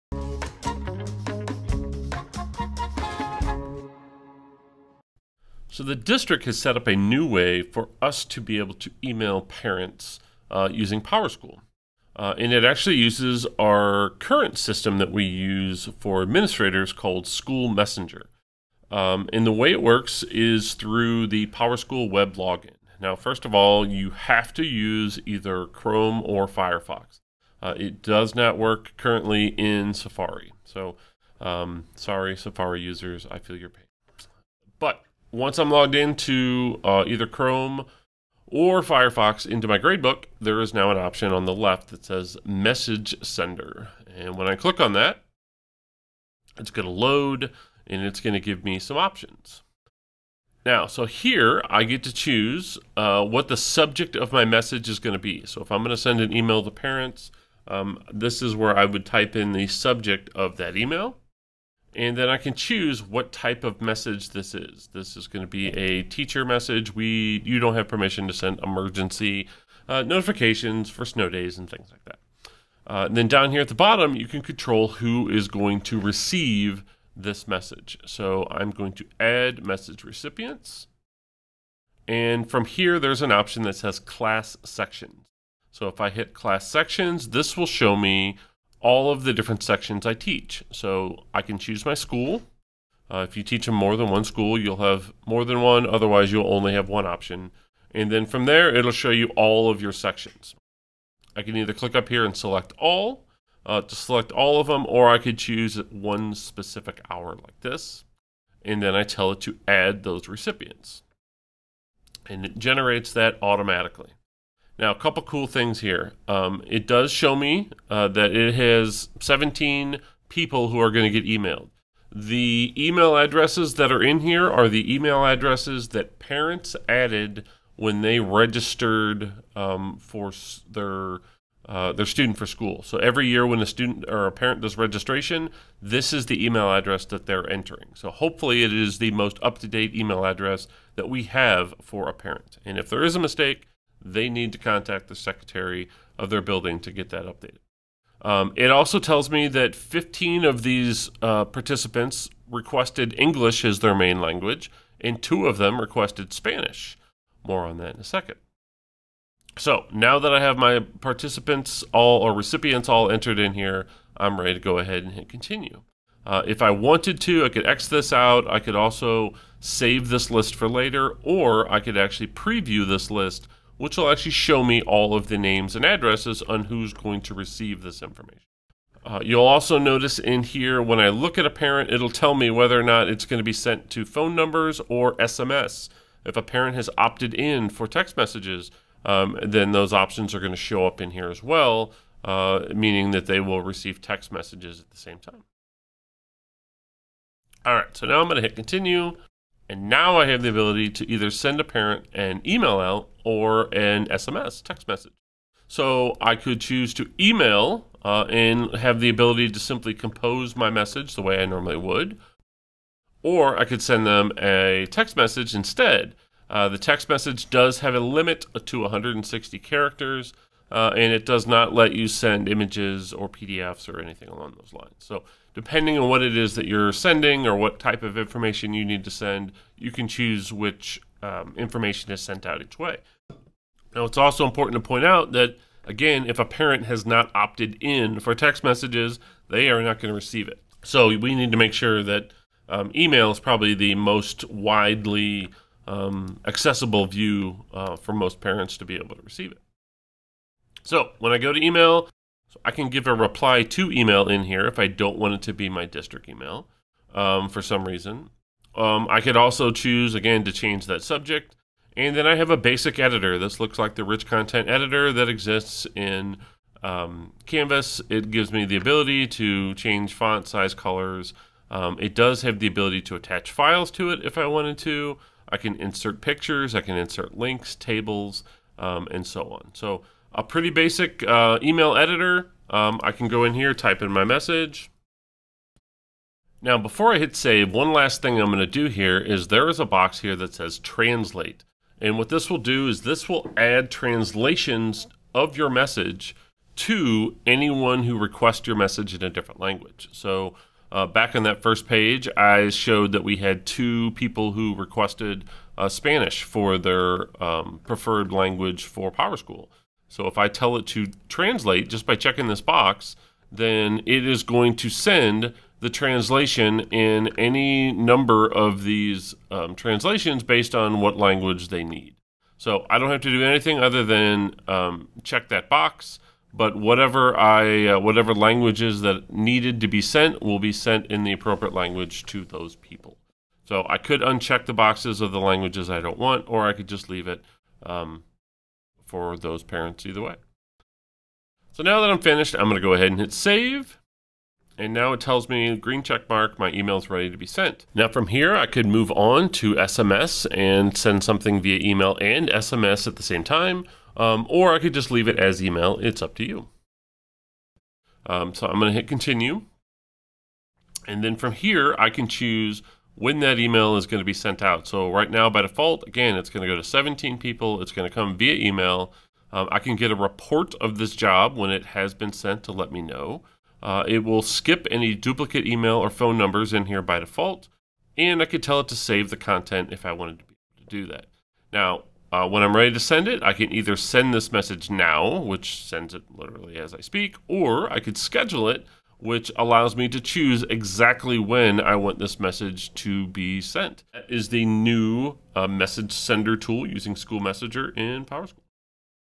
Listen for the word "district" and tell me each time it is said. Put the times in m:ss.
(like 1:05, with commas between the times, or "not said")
0:05, 4:15.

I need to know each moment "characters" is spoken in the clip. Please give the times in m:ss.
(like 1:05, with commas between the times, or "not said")
3:39.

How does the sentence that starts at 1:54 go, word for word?
Now, a couple cool things here.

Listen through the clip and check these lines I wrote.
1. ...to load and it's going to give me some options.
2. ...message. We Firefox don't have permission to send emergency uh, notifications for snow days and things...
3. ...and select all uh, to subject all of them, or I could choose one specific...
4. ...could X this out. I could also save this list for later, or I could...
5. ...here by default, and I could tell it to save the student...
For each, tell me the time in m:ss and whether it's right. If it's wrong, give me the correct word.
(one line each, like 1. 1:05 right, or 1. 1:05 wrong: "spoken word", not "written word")
1. 0:46 right
2. 1:06 wrong: "You", not "Firefox"
3. 1:42 wrong: "select", not "subject"
4. 2:47 right
5. 6:16 wrong: "content", not "student".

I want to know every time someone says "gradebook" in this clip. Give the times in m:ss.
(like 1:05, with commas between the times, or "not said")
0:39.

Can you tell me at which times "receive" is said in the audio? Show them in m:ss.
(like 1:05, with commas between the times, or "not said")
1:15, 2:57, 3:13, 4:00, 4:09.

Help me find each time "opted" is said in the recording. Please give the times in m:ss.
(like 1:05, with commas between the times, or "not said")
3:06, 3:57.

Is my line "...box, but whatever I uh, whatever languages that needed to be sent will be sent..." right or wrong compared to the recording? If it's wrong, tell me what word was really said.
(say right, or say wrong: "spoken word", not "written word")
right.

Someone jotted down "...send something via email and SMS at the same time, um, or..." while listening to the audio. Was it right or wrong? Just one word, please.
right.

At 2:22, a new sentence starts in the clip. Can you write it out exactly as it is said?
And if there is a mistake, they need to contact the secretary of their building to get that updated.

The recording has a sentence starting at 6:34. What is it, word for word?
That is the new uh, message sender tool using School Messenger in PowerSchool.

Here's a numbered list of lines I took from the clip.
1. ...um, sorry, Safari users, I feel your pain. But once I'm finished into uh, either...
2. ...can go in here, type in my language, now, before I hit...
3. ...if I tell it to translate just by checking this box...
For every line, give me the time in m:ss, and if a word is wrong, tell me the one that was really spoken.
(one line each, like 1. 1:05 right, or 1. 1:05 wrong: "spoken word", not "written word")
1. 0:31 wrong: "logged", not "finished"
2. 4:43 wrong: "message", not "language"
3. 5:10 right.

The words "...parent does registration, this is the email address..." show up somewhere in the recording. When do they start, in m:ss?
2:14.